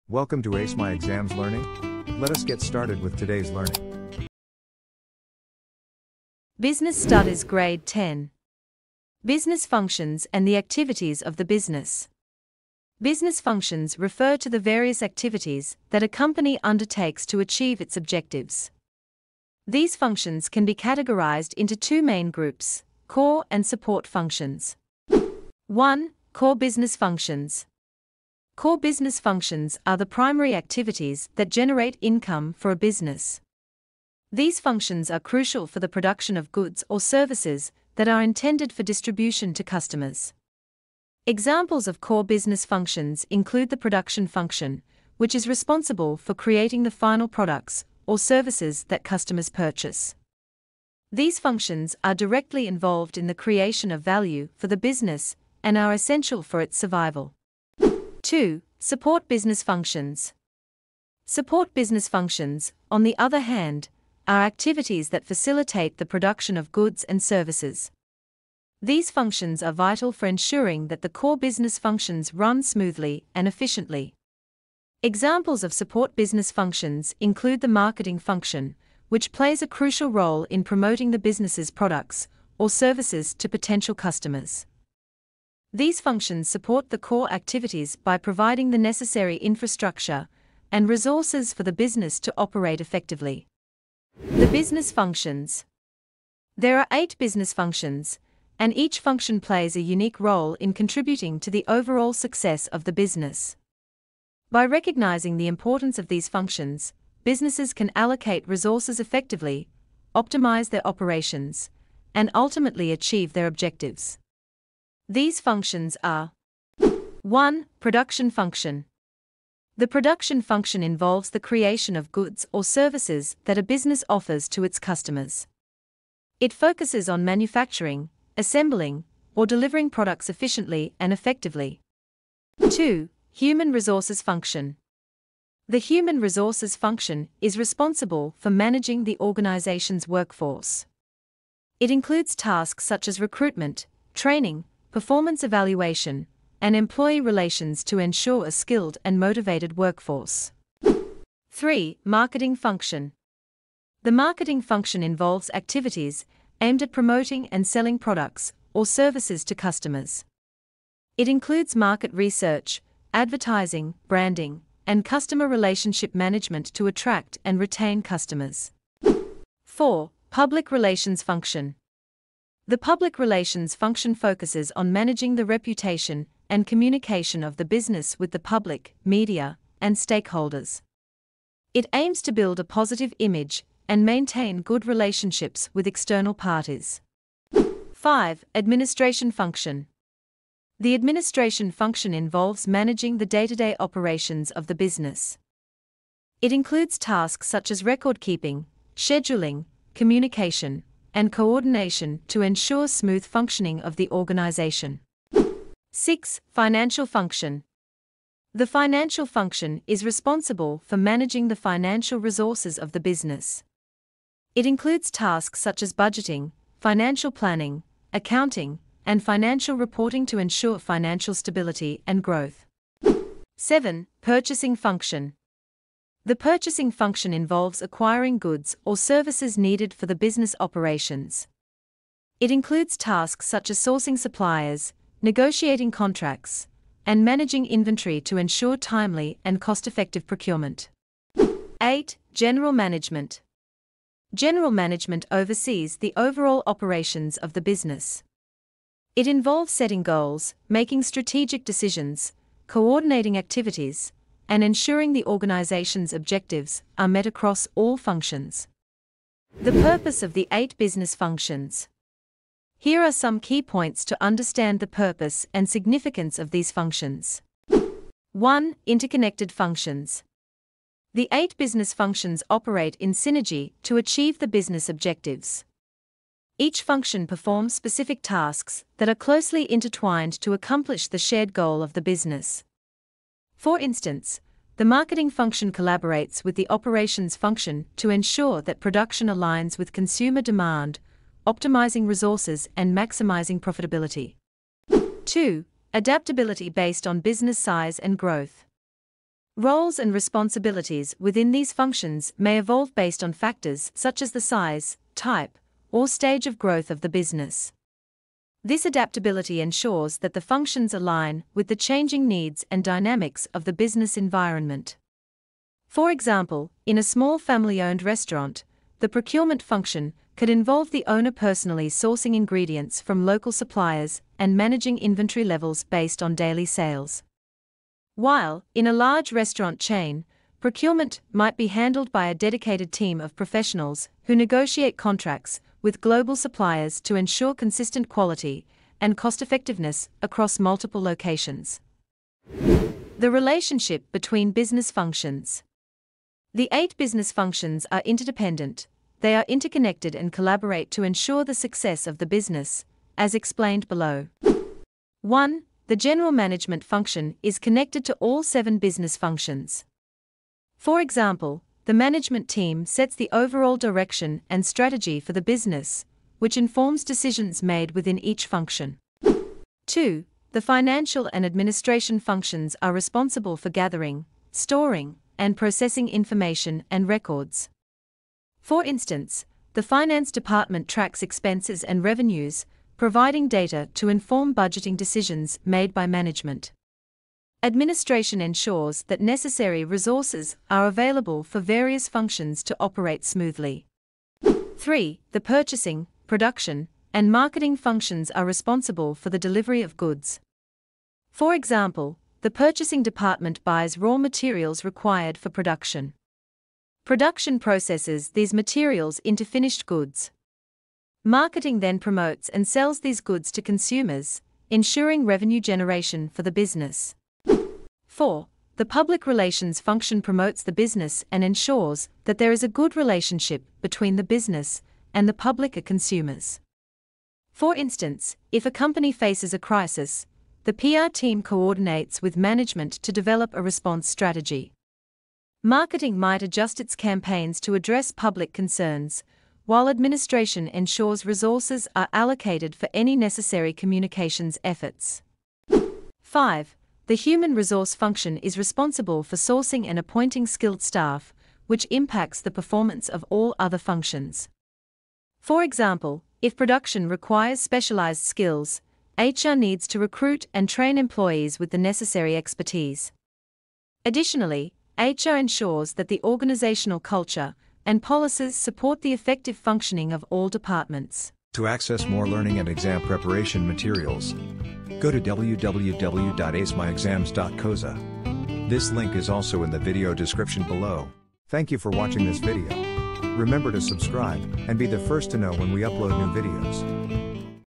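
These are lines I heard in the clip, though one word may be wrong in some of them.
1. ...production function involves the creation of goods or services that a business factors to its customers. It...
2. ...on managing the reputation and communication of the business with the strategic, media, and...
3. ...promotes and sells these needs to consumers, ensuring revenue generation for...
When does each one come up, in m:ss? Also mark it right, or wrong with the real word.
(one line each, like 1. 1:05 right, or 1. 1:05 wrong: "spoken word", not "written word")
1. 1:59 wrong: "offers", not "factors"
2. 2:54 wrong: "public", not "strategic"
3. 6:51 wrong: "goods", not "needs".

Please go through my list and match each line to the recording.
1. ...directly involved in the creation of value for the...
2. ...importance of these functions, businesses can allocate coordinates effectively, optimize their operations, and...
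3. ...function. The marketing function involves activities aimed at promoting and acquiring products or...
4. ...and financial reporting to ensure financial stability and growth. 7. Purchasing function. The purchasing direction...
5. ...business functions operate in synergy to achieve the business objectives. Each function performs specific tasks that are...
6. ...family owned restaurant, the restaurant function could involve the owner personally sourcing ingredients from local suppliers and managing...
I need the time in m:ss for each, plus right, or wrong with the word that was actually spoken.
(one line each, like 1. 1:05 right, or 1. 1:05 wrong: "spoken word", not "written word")
1. 0:52 right
2. 1:45 wrong: "resources", not "coordinates"
3. 2:32 wrong: "selling", not "acquiring"
4. 3:39 wrong: "function", not "direction"
5. 4:31 right
6. 5:17 wrong: "procurement", not "restaurant".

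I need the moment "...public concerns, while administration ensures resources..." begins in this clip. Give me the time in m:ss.
7:18.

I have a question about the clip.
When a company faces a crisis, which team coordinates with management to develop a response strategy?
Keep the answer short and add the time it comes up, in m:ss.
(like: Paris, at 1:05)
PR team, at 7:10.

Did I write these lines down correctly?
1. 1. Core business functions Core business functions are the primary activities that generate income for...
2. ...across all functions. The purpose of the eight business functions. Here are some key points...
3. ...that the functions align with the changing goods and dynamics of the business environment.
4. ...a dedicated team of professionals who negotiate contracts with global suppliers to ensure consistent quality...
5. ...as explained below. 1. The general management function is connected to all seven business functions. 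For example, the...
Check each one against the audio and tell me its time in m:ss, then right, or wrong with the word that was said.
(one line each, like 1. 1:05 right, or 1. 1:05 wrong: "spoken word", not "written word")
1. 0:25 right
2. 4:17 right
3. 5:10 wrong: "needs", not "goods"
4. 5:32 right
5. 5:53 right.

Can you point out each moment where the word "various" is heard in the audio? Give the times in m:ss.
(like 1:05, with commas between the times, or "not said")
0:14, 6:31.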